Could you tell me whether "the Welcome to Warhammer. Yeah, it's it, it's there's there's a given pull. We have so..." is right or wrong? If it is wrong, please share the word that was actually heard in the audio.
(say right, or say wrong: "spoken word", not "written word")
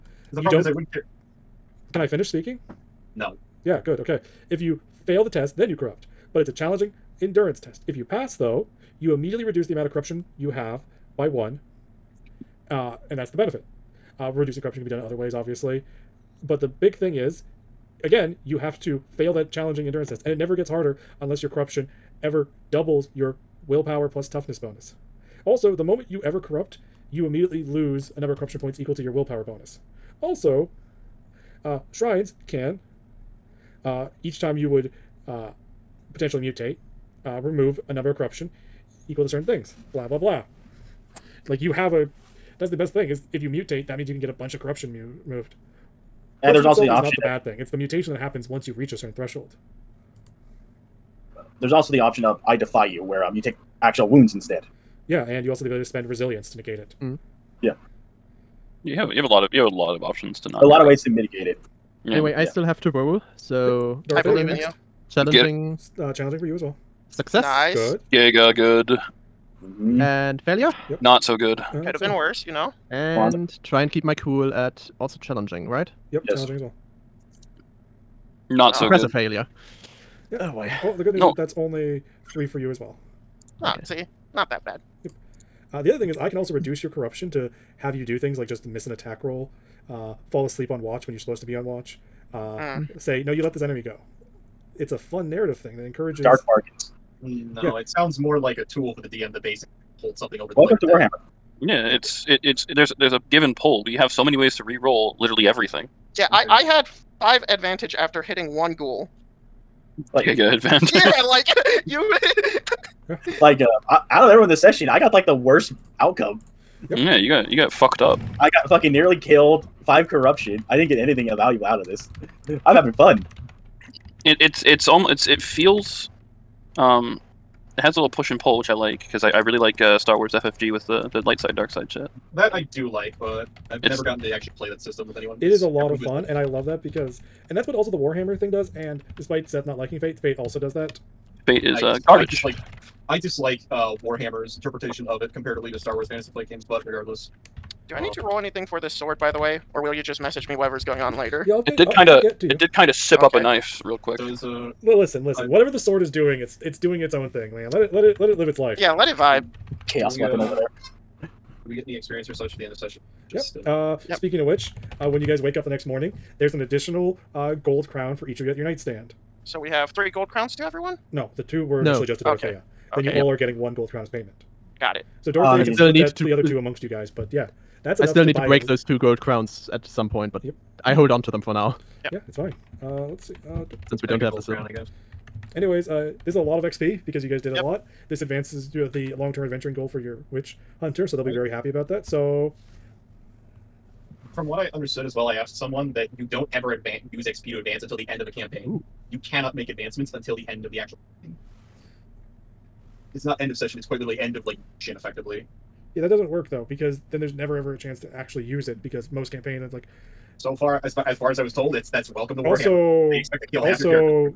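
right.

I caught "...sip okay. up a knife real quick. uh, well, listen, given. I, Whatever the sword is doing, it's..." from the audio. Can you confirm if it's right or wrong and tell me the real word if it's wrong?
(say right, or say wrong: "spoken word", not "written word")
wrong: "listen", not "given".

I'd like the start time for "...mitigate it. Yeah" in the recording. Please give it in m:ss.
1:01.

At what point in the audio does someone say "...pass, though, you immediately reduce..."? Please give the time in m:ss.
0:08.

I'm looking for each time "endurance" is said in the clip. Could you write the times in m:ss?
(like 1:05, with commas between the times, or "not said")
0:07, 0:19.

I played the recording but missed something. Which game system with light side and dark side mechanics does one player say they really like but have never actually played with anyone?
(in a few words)
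Star Wars FFG.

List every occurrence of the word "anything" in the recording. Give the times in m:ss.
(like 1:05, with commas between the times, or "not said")
2:00, 2:28.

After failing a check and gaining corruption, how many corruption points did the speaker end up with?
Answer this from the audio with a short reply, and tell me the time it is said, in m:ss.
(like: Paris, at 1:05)
5, at 1:59.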